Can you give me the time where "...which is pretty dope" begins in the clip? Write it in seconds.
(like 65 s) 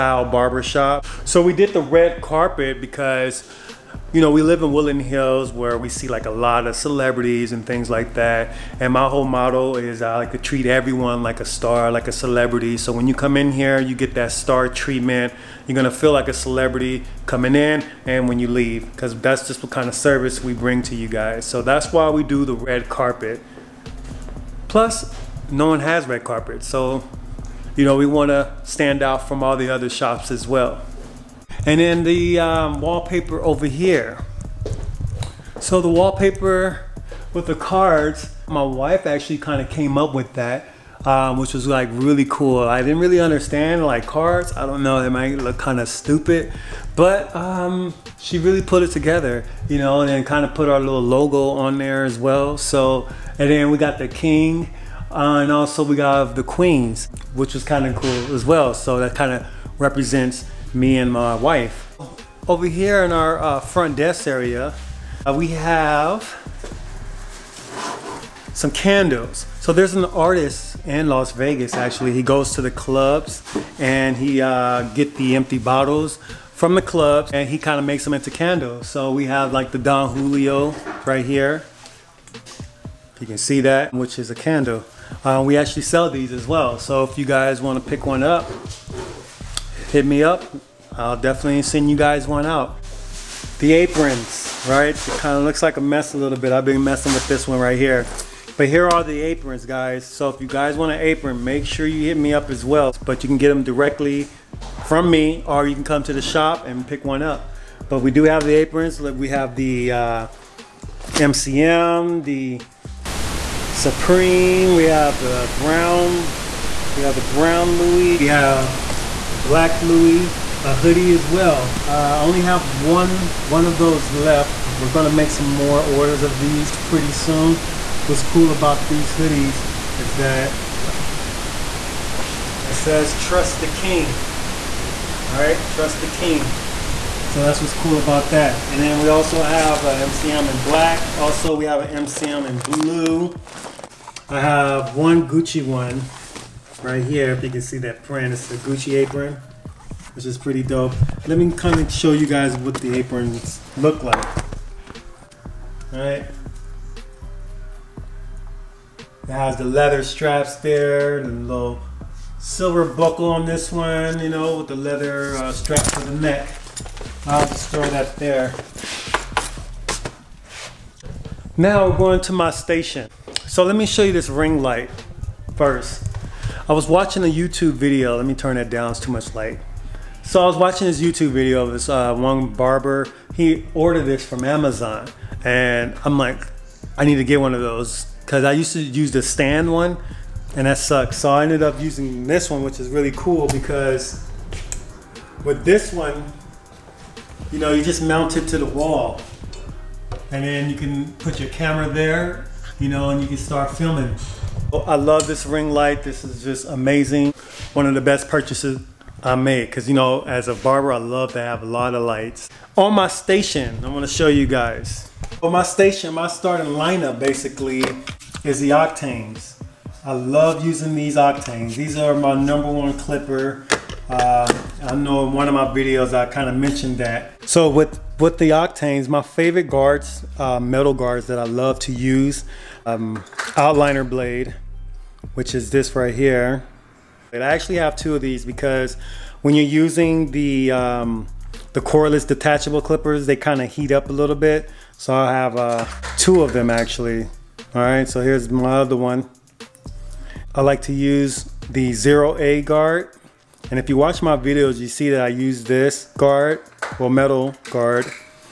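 150 s.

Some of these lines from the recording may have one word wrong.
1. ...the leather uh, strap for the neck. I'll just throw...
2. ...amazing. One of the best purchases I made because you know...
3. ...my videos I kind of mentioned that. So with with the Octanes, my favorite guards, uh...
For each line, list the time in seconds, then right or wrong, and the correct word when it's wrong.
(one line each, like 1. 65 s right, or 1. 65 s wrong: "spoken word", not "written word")
1. 164 s right
2. 206 s right
3. 225 s right.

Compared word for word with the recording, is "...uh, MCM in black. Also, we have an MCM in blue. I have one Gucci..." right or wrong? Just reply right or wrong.
right.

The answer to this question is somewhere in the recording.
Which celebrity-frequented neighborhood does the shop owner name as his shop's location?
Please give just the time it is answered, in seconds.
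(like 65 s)
4 s.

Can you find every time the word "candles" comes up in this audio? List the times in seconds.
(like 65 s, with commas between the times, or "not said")
68 s, 78 s, 84 s.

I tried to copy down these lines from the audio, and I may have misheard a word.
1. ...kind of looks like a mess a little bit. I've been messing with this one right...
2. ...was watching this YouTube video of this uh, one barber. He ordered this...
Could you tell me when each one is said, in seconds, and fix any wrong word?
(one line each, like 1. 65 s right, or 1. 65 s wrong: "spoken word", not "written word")
1. 95 s right
2. 180 s right.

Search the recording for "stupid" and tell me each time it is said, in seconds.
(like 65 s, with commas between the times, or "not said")
45 s.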